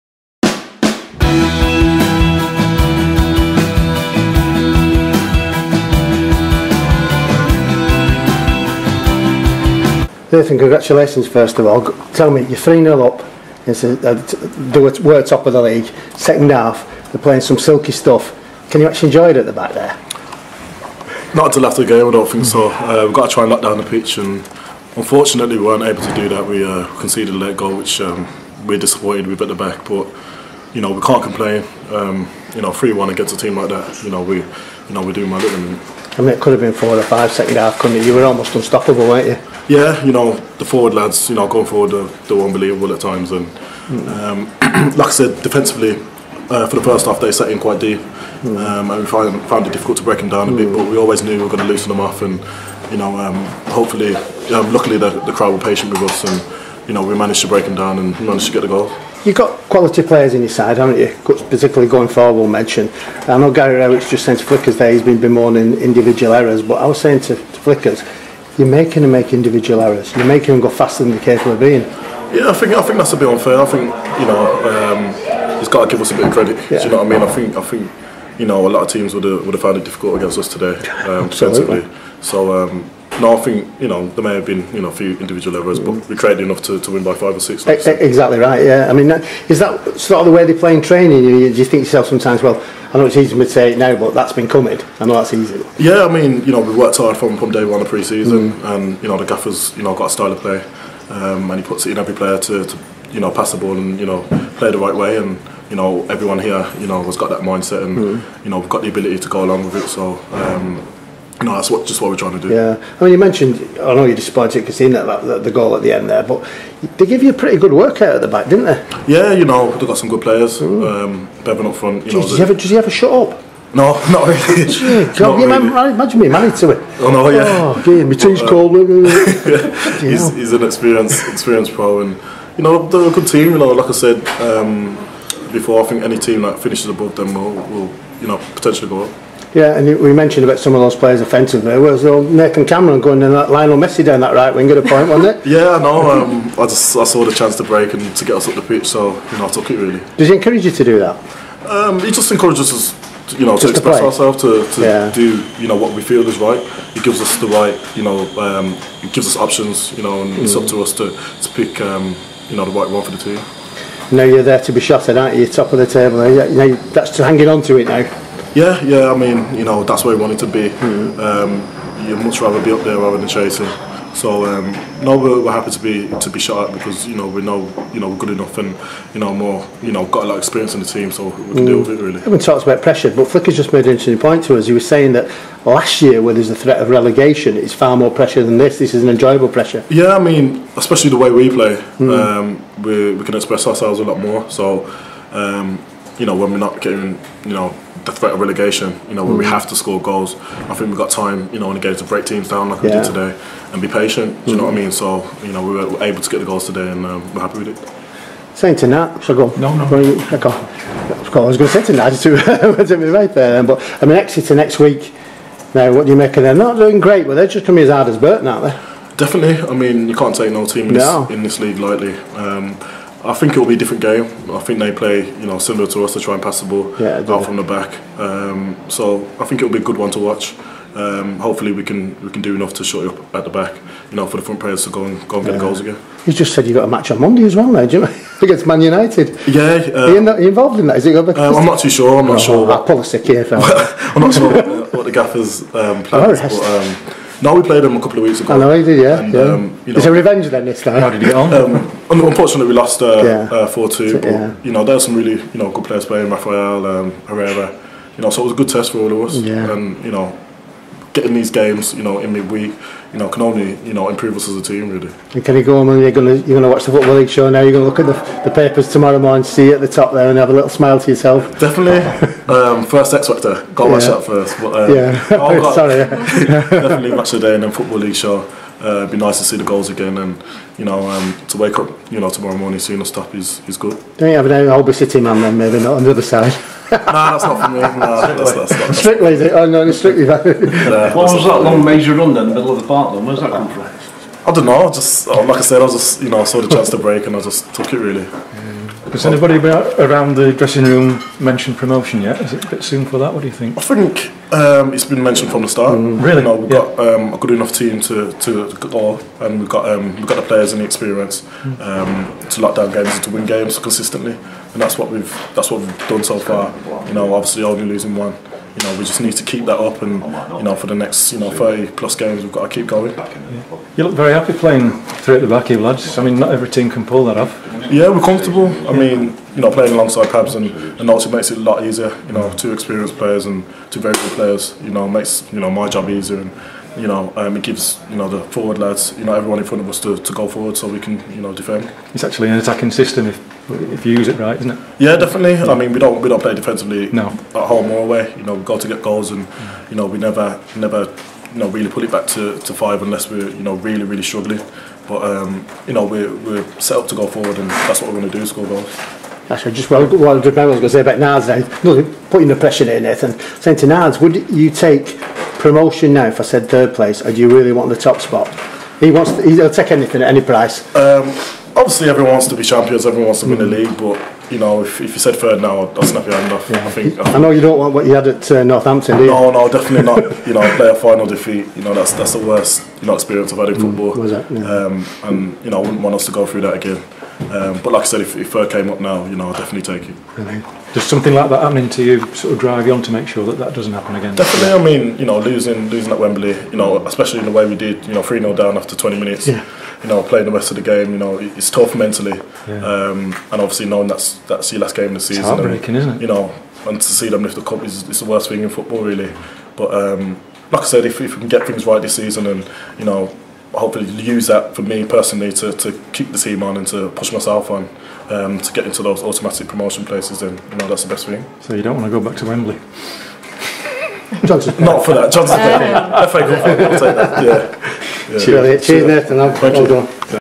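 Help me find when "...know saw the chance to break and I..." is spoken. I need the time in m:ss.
4:56.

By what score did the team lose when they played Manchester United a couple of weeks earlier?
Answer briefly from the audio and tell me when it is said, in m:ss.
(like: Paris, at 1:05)
4-2, at 4:13.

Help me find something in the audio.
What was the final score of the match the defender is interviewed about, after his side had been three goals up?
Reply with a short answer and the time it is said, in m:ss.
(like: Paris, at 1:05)
3-1, at 0:32.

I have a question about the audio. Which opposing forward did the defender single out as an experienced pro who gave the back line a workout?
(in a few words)
Beavon.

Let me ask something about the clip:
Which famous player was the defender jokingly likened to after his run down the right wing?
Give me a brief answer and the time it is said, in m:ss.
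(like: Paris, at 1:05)
Lionel Messi, at 2:23.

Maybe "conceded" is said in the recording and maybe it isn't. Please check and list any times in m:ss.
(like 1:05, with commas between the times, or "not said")
0:26.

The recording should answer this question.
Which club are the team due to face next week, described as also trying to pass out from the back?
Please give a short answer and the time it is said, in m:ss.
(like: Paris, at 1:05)
Exeter, at 3:34.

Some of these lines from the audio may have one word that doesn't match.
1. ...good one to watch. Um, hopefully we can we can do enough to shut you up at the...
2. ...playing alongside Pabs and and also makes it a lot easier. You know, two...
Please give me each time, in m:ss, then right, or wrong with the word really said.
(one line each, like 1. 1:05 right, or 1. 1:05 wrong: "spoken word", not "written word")
1. 3:49 right
2. 5:29 right.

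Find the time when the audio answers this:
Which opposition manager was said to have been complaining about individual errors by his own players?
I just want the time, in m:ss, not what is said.
1:03.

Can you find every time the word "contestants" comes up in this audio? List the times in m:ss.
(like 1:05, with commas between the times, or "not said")
not said.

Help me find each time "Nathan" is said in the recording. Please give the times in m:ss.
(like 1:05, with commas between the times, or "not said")
0:10, 2:22, 6:03.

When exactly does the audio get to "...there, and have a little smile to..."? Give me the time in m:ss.
4:30.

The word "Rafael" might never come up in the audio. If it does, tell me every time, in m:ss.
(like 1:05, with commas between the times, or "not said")
4:16.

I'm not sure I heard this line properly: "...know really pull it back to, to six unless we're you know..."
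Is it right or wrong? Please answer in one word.
wrong.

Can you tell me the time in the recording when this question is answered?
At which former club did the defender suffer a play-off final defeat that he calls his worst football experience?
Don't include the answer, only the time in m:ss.
6:18.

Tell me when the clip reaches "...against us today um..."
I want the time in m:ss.
1:20.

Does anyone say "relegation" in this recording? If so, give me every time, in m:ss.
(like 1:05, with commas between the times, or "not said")
3:06, 3:18.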